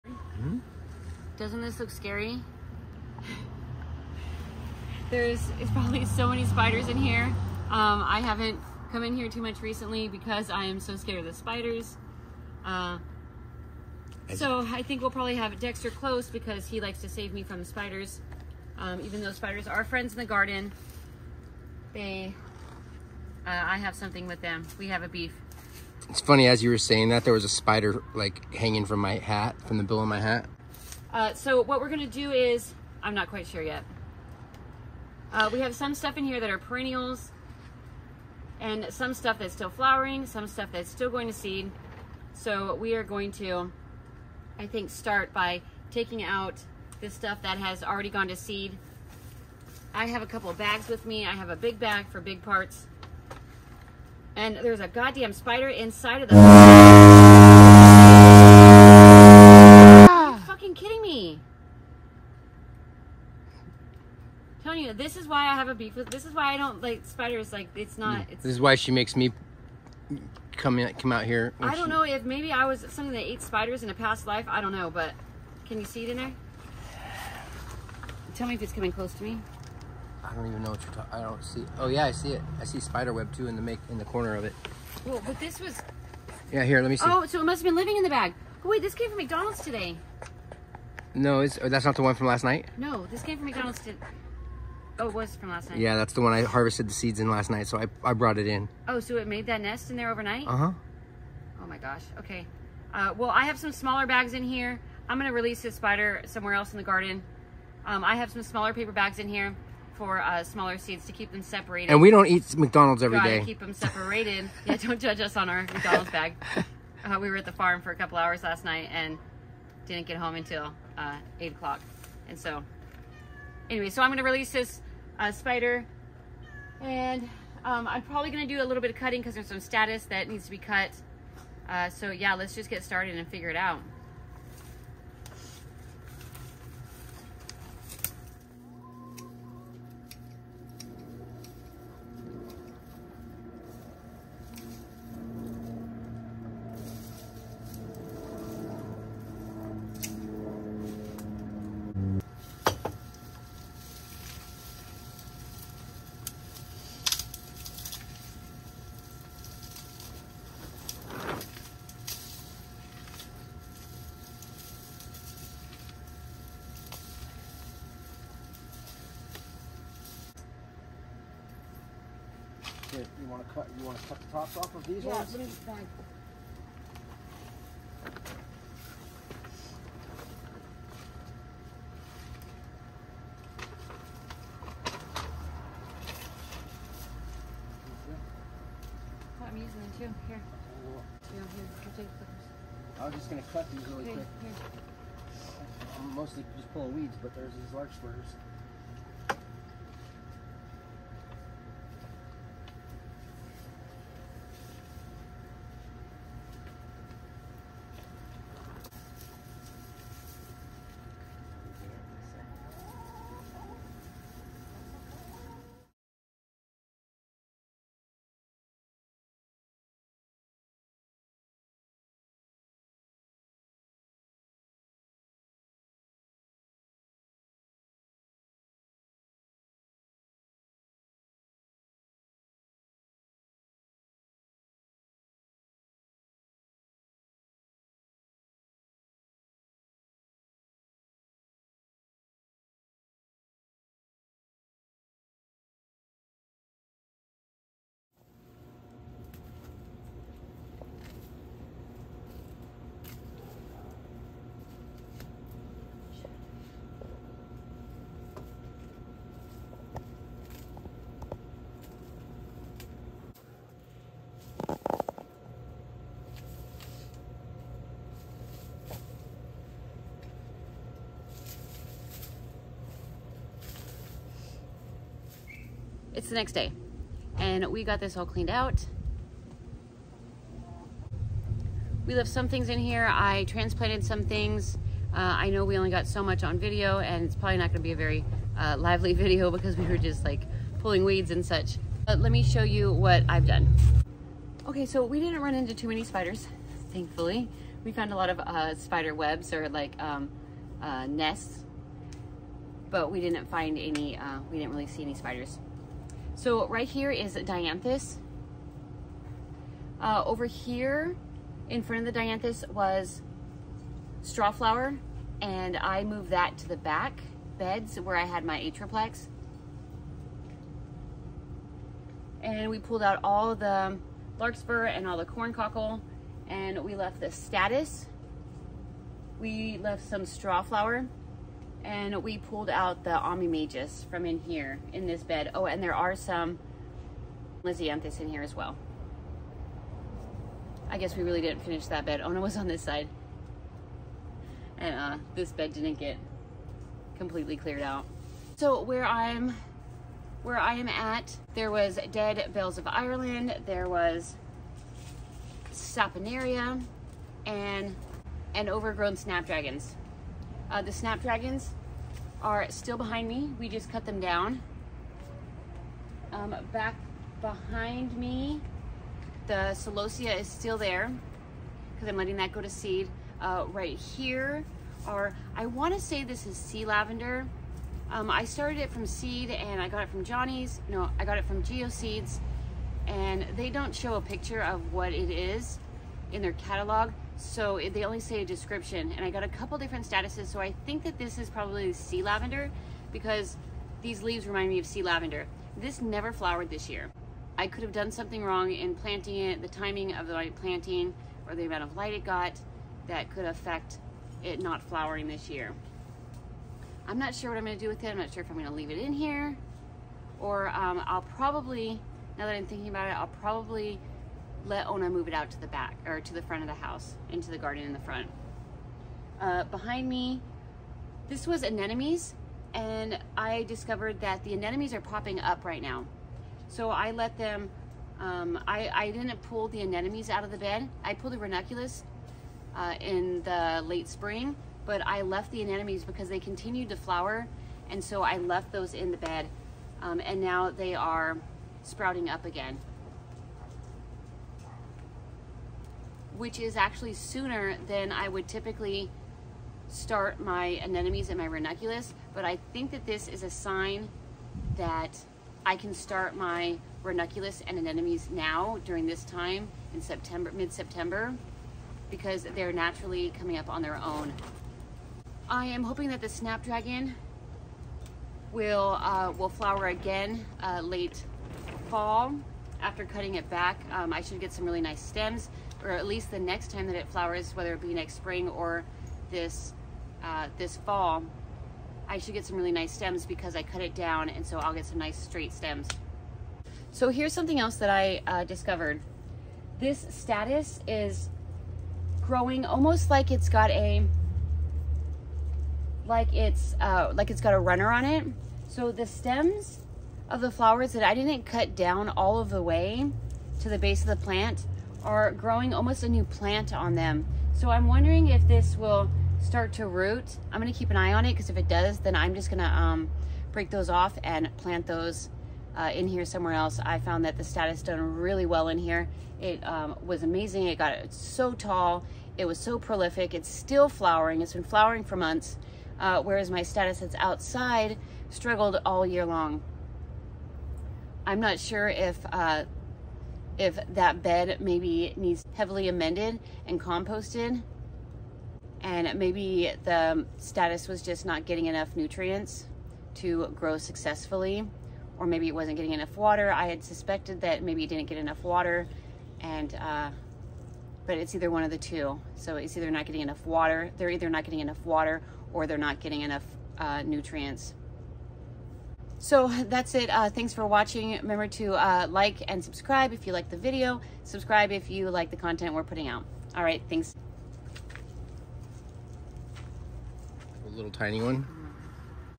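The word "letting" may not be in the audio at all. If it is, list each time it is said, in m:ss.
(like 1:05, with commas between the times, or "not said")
6:12.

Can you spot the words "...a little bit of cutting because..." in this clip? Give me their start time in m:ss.
2:08.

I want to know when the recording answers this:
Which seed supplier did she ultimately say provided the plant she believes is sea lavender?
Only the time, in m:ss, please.
6:21.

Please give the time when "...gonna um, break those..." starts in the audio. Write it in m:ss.
8:32.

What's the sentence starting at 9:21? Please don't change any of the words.
Remember to uh, like and subscribe if you like the video.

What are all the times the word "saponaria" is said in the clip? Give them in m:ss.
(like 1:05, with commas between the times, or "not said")
5:55.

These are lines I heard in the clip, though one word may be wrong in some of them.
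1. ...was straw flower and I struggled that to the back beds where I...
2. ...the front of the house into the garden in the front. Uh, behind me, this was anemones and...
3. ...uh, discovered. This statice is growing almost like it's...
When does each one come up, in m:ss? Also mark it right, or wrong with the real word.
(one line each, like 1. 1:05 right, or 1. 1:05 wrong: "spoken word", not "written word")
1. 5:12 wrong: "moved", not "struggled"
2. 6:56 right
3. 8:08 right.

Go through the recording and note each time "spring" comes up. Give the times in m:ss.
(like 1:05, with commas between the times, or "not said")
7:14, 7:58.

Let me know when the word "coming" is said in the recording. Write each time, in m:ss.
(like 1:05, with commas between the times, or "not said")
1:18, 7:43.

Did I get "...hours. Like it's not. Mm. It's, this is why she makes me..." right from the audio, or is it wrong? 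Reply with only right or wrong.
wrong.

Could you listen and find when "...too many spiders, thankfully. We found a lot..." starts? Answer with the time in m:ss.
4:55.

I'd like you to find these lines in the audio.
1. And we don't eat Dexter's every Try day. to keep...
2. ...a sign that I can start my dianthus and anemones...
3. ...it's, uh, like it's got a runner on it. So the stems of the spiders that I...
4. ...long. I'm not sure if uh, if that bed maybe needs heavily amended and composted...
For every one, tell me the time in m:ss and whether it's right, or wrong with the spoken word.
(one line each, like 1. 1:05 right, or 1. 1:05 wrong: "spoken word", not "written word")
1. 1:51 wrong: "McDonald", not "Dexter"
2. 7:33 wrong: "ranunculus", not "dianthus"
3. 8:16 wrong: "flowers", not "spiders"
4. 8:49 right.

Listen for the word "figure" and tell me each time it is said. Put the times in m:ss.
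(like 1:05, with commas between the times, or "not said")
2:13.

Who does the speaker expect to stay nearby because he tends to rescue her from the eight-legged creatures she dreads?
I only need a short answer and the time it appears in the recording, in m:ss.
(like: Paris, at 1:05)
Dexter, at 0:15.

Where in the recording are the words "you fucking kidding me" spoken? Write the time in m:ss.
0:59.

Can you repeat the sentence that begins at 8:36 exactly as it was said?
I found that the statice done really well in here.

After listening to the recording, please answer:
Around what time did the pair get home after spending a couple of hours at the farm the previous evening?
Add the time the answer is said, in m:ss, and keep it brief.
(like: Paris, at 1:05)
8 o'clock, at 2:01.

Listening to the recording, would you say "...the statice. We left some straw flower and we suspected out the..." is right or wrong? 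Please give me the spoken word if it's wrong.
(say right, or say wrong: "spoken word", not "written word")
wrong: "pulled", not "suspected".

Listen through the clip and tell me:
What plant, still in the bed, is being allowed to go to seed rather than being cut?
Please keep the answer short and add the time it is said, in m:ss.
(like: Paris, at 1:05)
Celosia, at 6:09.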